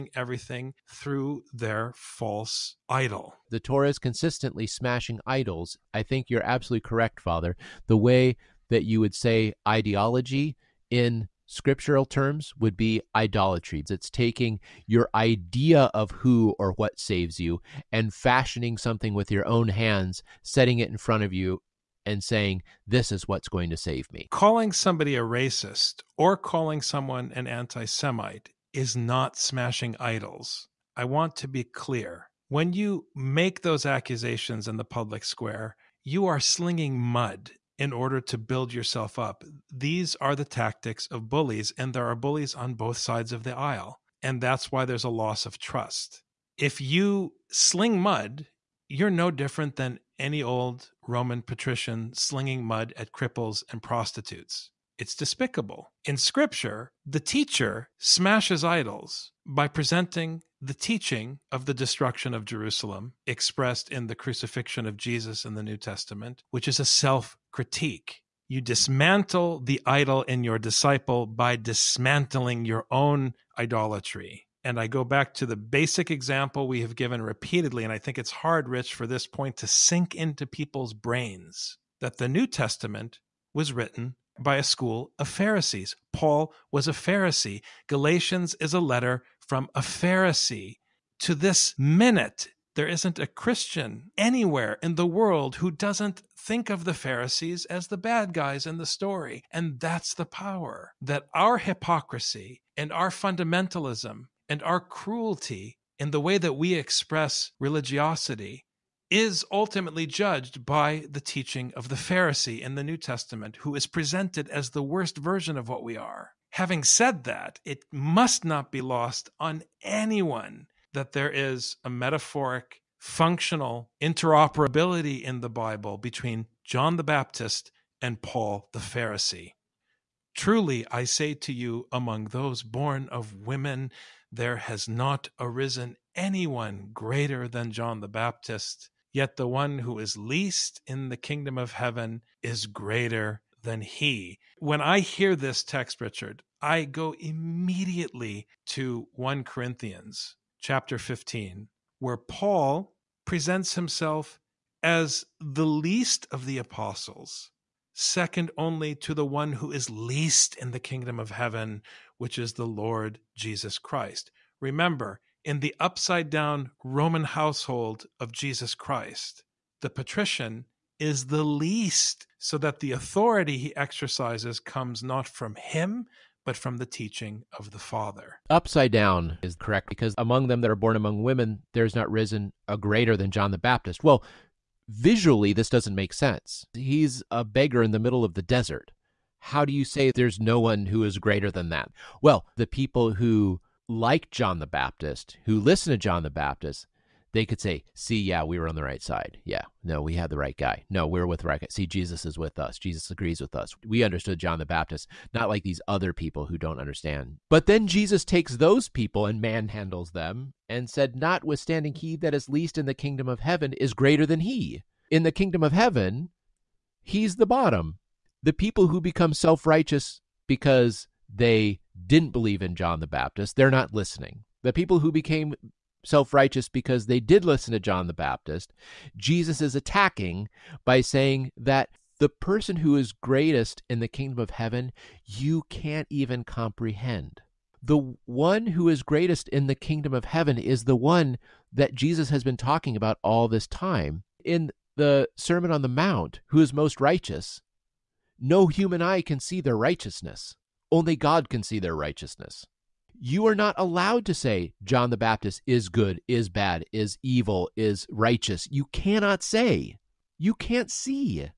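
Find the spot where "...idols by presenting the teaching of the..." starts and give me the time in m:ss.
0:58.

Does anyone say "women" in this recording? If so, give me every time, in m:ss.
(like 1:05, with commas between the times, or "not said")
2:13, 3:01.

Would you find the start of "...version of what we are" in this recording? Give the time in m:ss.
1:55.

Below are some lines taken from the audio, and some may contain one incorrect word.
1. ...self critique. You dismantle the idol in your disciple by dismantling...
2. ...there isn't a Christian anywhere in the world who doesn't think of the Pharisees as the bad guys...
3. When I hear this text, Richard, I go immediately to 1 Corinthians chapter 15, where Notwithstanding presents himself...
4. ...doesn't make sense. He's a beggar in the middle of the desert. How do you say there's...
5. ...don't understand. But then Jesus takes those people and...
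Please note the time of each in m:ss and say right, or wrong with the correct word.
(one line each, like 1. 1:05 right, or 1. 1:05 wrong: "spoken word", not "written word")
1. 1:06 right
2. 1:32 right
3. 2:24 wrong: "Paul", not "Notwithstanding"
4. 3:05 right
5. 3:26 right.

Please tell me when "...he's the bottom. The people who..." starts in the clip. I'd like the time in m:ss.
3:37.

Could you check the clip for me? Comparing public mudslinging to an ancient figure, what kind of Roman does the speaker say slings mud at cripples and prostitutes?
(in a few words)
Roman patrician.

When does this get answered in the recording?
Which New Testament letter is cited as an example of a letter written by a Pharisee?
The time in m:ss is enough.
1:27.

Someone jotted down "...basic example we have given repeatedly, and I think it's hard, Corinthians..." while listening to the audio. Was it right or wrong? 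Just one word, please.
wrong.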